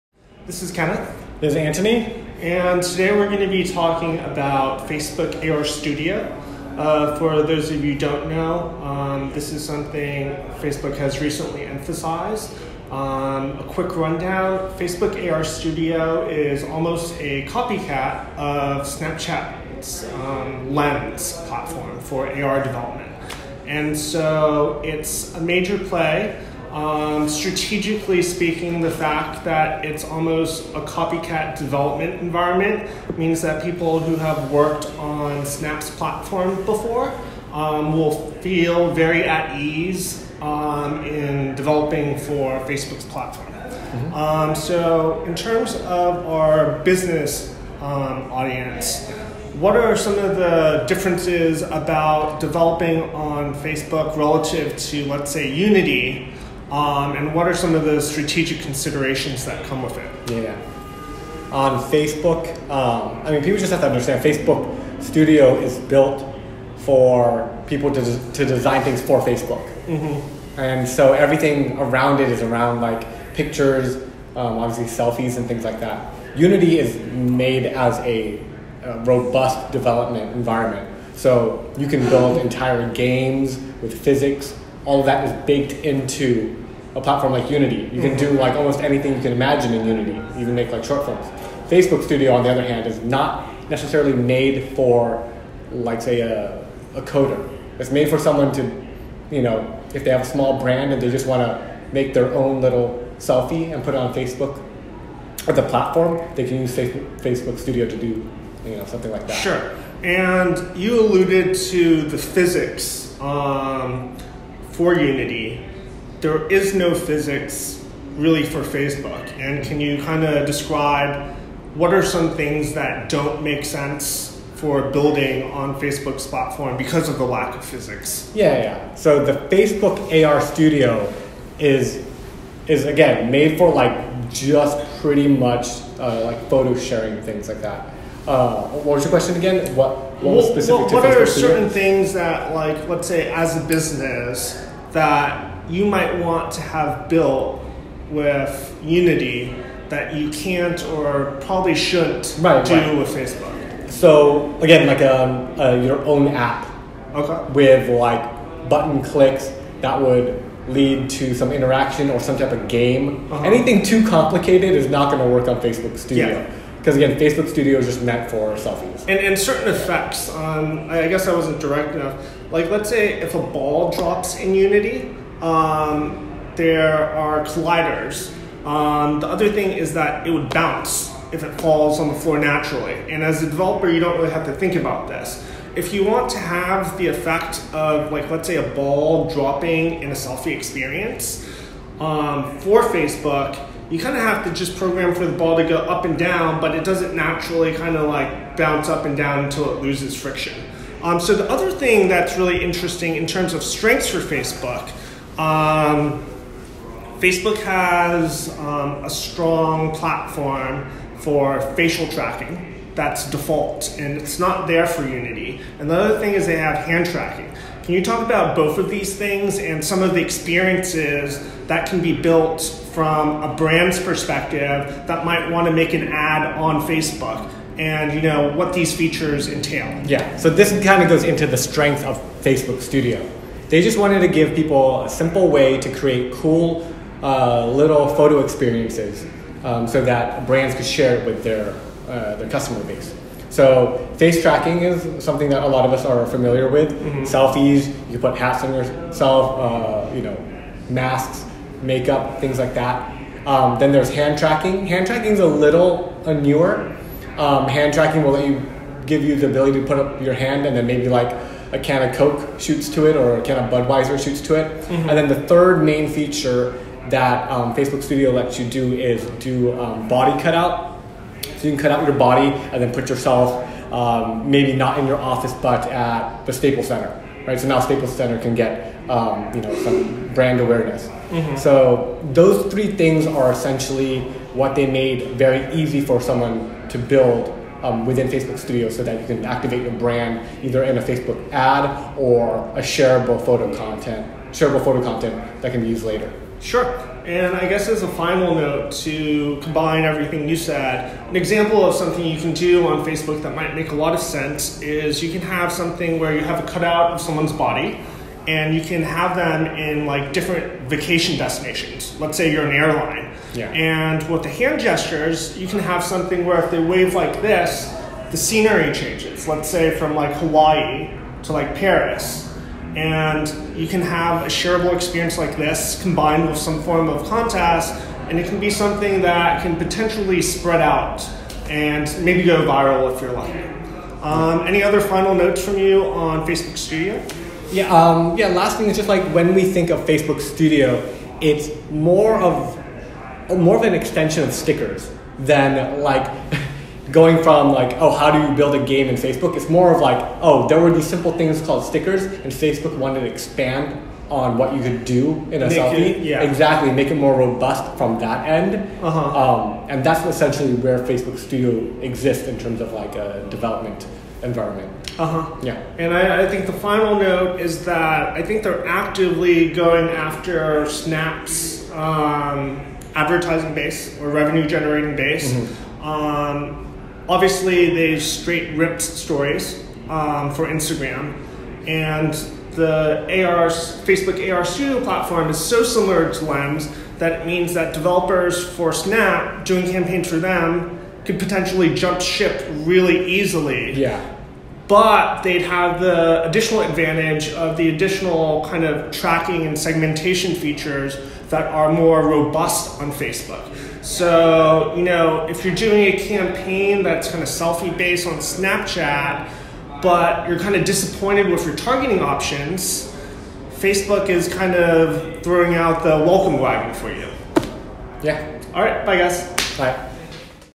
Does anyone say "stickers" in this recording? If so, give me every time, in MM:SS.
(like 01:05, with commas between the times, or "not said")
05:44, 05:51.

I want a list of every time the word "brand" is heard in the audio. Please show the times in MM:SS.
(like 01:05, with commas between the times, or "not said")
01:40, 03:43, 04:00, 04:40, 04:49.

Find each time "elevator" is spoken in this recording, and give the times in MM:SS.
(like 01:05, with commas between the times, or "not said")
not said.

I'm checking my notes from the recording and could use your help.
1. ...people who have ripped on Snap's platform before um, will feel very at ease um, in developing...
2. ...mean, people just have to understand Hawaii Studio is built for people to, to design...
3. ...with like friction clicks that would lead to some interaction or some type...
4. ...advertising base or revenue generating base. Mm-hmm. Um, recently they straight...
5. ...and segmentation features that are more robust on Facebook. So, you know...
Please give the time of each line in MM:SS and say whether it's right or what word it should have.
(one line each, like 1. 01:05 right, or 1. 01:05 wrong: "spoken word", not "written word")
1. 00:33 wrong: "worked", not "ripped"
2. 01:03 wrong: "Facebook", not "Hawaii"
3. 02:37 wrong: "button", not "friction"
4. 06:13 wrong: "obviously", not "recently"
5. 06:39 right.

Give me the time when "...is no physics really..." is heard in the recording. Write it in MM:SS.
01:56.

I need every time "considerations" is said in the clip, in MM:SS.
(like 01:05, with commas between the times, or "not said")
00:58.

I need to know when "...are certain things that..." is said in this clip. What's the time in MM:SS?
02:21.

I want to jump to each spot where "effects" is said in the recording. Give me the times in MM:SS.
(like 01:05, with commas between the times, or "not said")
02:49, 03:07.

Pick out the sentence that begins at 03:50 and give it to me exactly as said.
Yeah, so this kind of goes into the strength of Facebook Studio.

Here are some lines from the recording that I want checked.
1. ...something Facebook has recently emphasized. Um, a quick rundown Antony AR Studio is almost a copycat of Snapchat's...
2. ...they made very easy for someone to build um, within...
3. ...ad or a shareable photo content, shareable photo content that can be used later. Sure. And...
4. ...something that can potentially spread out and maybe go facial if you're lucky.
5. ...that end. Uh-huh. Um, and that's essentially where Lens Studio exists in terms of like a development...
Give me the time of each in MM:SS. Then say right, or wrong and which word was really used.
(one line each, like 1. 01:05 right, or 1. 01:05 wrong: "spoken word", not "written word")
1. 00:09 wrong: "Facebook", not "Antony"
2. 04:44 right
3. 04:51 right
4. 05:28 wrong: "viral", not "facial"
5. 05:58 wrong: "Facebook", not "Lens".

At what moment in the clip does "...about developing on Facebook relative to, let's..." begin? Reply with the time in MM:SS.
00:51.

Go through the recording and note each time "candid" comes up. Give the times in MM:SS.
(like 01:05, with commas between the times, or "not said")
not said.